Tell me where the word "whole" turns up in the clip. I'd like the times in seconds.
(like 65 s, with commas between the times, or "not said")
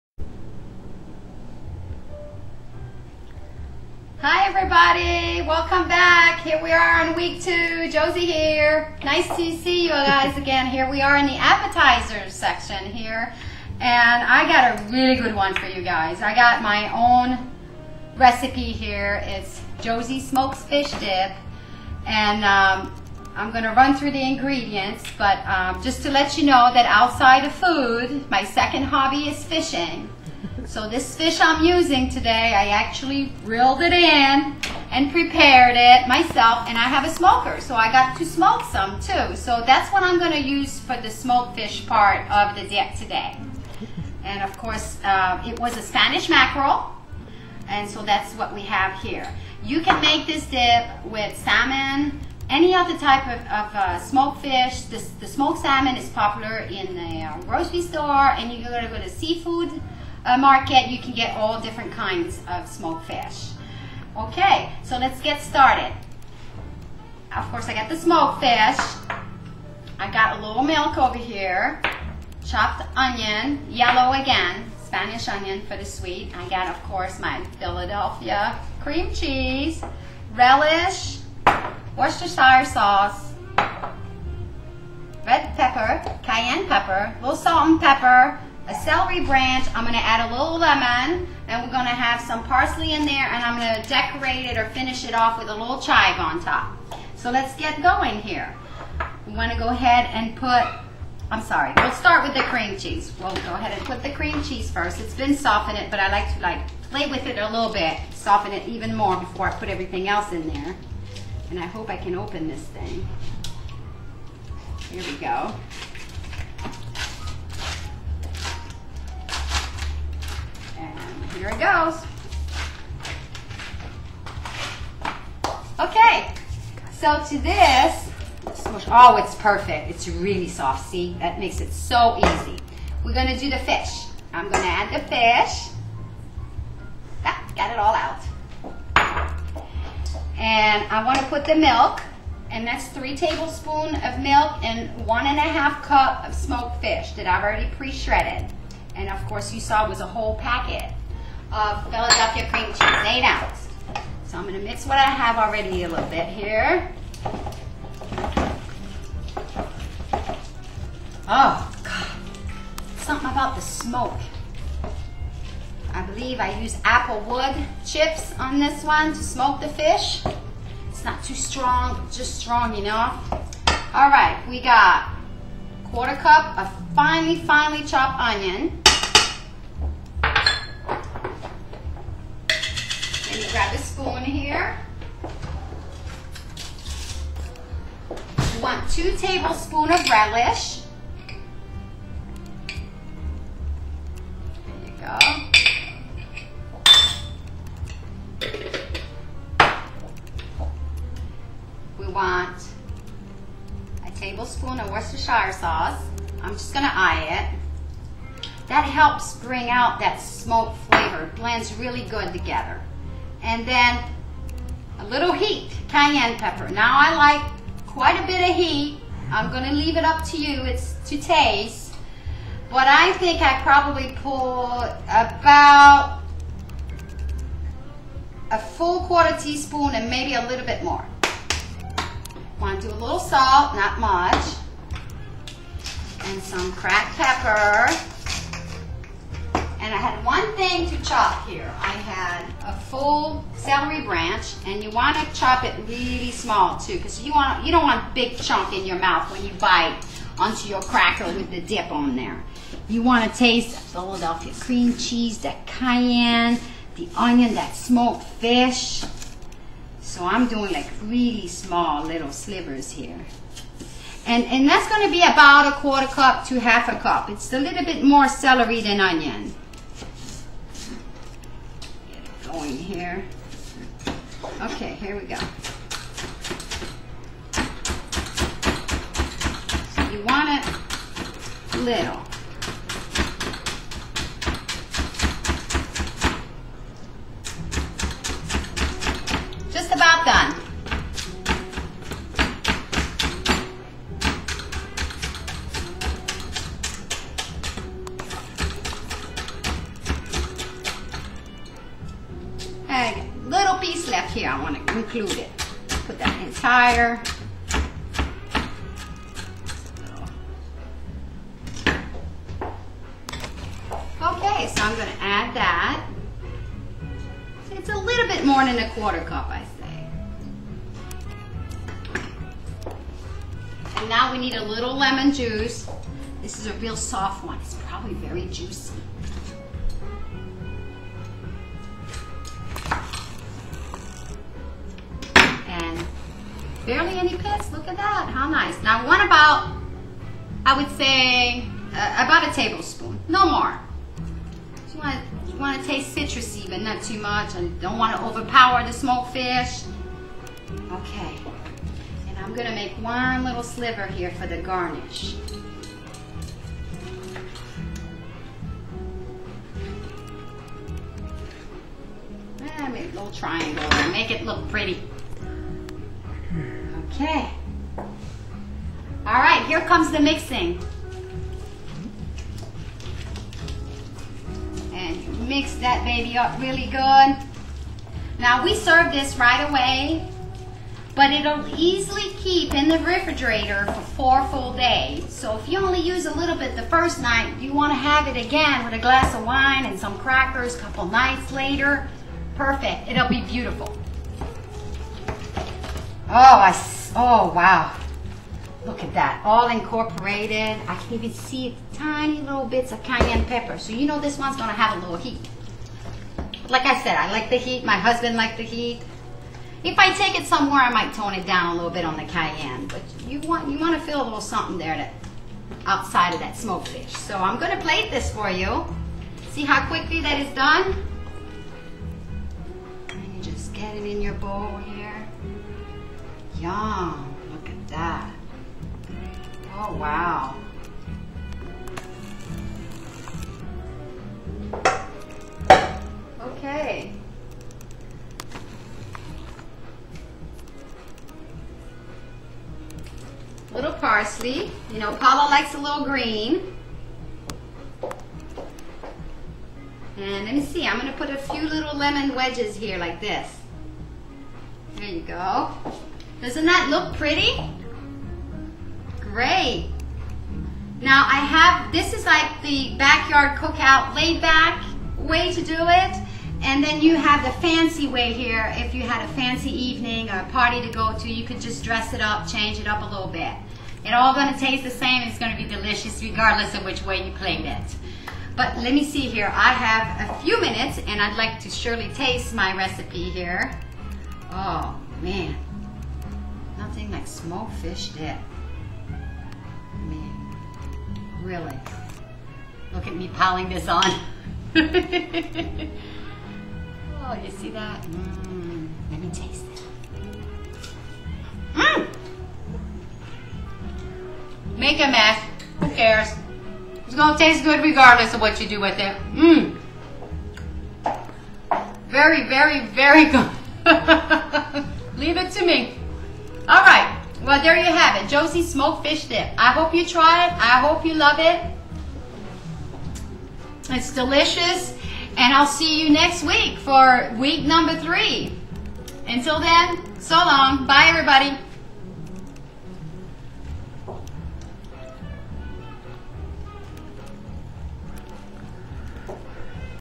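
150 s.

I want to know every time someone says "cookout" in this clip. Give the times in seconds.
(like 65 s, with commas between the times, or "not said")
463 s.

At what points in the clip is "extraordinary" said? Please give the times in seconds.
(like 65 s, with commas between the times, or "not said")
not said.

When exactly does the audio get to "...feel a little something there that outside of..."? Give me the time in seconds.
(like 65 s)
414 s.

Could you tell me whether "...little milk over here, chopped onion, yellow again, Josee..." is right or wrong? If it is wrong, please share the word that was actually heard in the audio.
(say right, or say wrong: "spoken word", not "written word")
wrong: "Spanish", not "Josee".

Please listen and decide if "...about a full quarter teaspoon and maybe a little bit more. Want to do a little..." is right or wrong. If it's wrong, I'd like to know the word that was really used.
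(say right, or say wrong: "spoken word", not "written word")
right.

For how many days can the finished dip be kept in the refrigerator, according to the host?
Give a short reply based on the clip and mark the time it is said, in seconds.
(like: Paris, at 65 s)
4 days, at 384 s.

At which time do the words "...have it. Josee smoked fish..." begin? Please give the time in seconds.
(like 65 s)
517 s.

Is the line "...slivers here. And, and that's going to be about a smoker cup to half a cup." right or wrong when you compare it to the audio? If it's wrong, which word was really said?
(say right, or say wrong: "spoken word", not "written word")
wrong: "quarter", not "smoker".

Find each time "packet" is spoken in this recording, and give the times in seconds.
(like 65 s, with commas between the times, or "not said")
150 s.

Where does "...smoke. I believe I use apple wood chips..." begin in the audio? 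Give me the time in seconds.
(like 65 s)
163 s.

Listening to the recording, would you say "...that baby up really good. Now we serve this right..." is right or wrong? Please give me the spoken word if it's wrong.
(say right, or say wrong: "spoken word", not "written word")
right.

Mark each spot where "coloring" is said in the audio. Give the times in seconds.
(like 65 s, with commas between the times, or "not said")
not said.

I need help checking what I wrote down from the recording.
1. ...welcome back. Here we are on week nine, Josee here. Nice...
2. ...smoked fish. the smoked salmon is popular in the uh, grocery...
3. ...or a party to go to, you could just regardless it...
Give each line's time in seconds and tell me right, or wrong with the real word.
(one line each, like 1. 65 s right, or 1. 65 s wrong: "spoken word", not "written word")
1. 5 s wrong: "two", not "nine"
2. 53 s right
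3. 470 s wrong: "dress", not "regardless".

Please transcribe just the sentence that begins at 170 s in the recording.
It's not too strong, just strong enough.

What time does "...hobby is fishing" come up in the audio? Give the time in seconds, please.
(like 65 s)
28 s.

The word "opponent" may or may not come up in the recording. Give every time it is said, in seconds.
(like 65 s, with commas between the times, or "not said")
not said.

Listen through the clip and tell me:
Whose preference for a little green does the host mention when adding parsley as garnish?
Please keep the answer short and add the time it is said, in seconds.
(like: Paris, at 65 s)
Paula, at 445 s.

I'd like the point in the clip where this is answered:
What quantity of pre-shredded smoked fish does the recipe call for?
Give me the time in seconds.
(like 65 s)
145 s.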